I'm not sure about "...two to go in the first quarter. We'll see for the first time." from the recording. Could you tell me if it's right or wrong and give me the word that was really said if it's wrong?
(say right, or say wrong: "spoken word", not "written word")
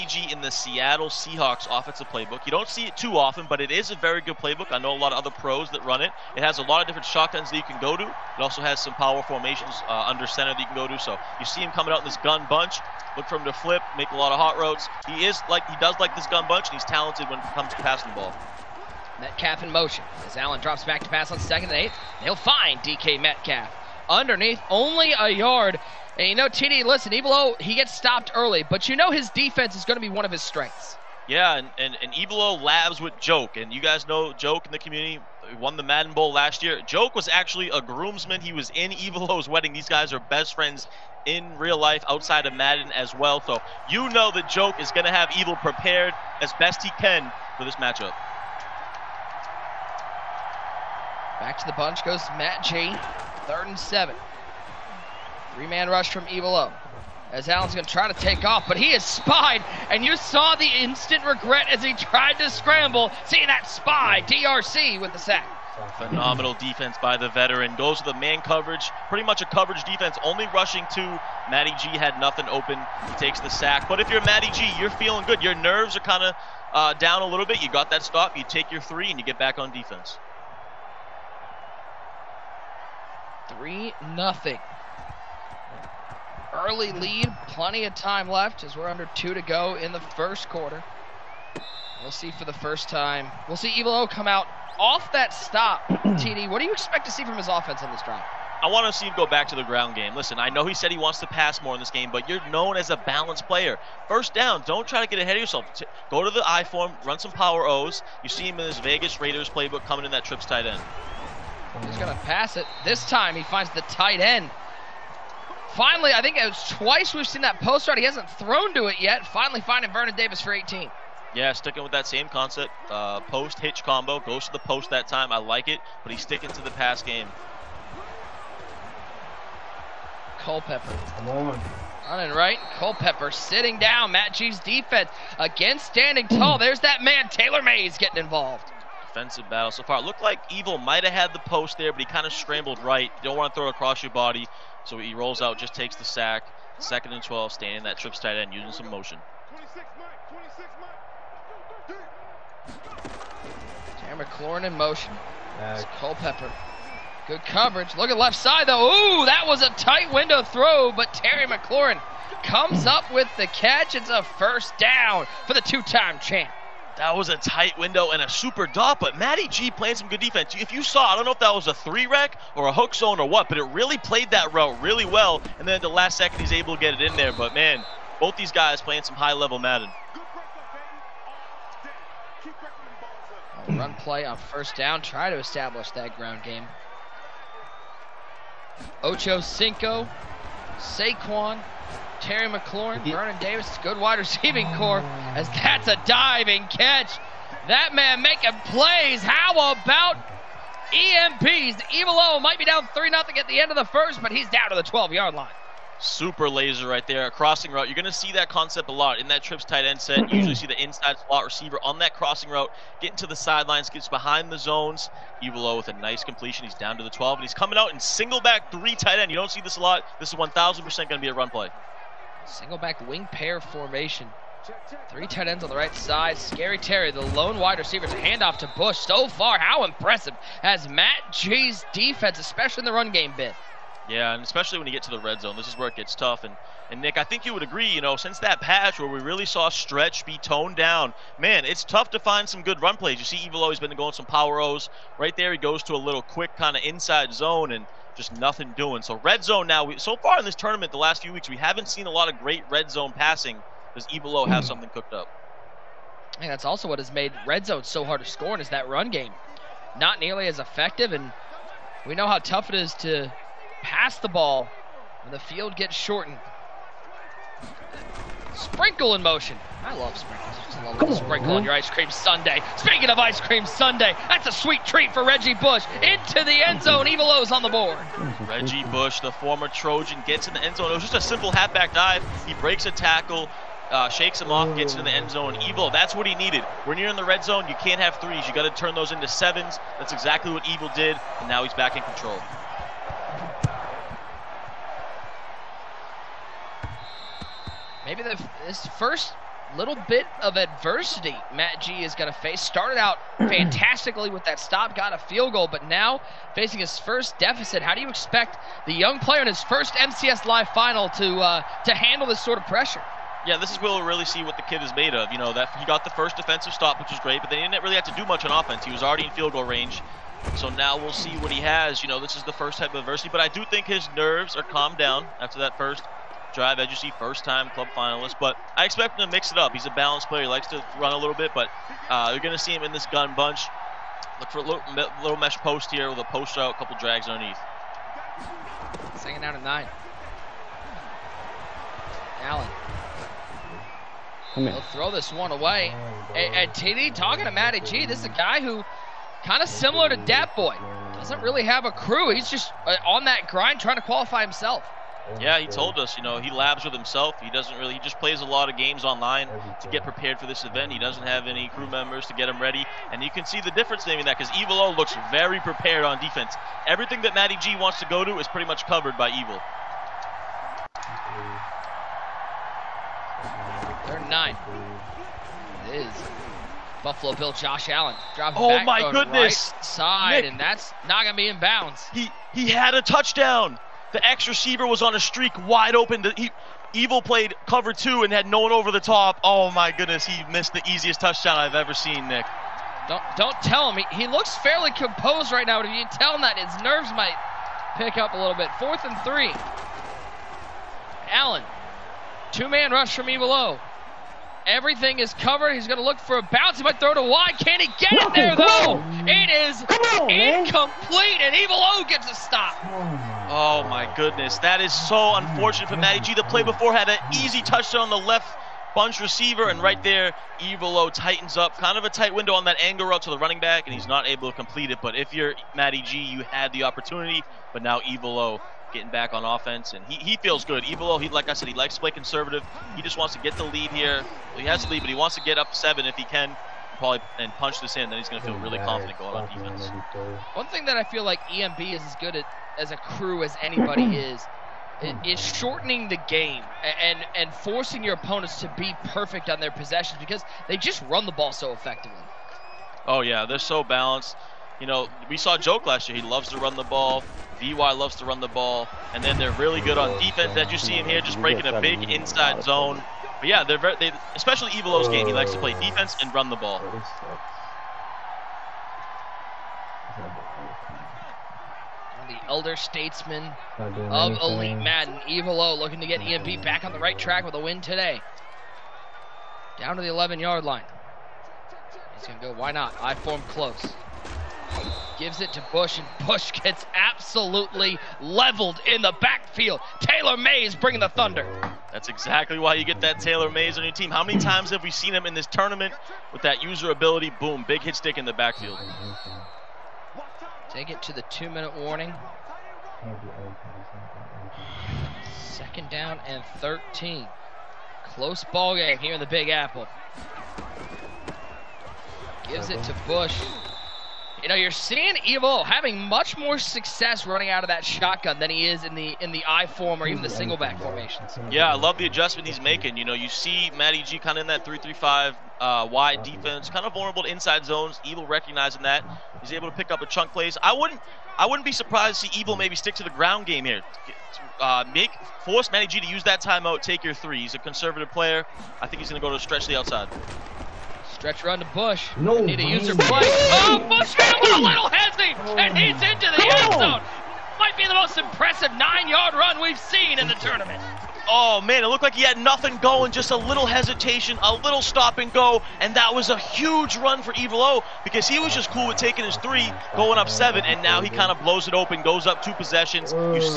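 right.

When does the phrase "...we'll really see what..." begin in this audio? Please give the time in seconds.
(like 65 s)
313 s.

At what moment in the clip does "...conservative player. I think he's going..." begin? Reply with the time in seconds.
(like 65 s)
537 s.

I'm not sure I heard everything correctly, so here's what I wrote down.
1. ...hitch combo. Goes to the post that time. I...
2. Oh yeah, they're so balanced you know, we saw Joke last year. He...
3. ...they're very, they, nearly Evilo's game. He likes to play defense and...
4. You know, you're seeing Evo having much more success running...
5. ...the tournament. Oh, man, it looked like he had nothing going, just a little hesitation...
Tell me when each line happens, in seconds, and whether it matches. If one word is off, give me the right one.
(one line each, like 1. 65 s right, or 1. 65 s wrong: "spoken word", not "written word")
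1. 123 s right
2. 453 s right
3. 463 s wrong: "especially", not "nearly"
4. 514 s right
5. 550 s right.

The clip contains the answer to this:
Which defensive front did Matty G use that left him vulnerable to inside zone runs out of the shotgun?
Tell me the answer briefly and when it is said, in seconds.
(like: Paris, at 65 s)
3-3-5 wide, at 524 s.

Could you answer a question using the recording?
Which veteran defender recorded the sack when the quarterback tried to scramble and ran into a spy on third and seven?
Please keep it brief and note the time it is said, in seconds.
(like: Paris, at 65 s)
DRC, at 64 s.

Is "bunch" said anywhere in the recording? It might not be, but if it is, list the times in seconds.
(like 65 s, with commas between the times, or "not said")
12 s, 16 s, 51 s, 333 s, 418 s.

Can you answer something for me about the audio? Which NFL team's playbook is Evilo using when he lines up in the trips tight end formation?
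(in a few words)
Vegas Raiders.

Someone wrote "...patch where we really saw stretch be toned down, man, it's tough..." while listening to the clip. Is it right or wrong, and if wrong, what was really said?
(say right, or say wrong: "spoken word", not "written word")
right.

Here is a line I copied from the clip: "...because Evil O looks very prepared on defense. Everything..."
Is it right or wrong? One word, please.
right.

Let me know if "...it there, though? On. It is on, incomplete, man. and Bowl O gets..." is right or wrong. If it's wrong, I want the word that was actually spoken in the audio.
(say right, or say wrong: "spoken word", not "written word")
wrong: "Evil", not "Bowl".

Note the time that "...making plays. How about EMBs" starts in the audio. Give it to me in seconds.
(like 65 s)
198 s.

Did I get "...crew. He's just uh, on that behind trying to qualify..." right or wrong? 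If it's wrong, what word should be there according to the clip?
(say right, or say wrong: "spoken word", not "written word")
wrong: "grind", not "behind".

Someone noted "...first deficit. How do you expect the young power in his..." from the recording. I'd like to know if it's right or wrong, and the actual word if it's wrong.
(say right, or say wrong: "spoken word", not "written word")
wrong: "player", not "power".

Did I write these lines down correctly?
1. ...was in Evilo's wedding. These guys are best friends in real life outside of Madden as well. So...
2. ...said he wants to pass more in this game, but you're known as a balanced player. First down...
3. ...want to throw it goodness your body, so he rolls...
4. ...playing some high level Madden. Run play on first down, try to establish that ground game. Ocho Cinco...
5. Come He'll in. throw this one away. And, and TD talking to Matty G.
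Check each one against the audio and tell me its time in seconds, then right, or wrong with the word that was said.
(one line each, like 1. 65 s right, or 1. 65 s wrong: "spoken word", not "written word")
1. 38 s right
2. 100 s right
3. 143 s wrong: "across", not "goodness"
4. 178 s right
5. 344 s right.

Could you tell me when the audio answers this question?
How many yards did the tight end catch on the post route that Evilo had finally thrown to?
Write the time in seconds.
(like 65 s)
120 s.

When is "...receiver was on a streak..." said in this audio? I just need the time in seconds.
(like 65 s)
384 s.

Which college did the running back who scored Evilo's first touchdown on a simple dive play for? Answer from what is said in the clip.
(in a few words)
Trojan.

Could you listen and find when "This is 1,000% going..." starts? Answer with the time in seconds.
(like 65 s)
220 s.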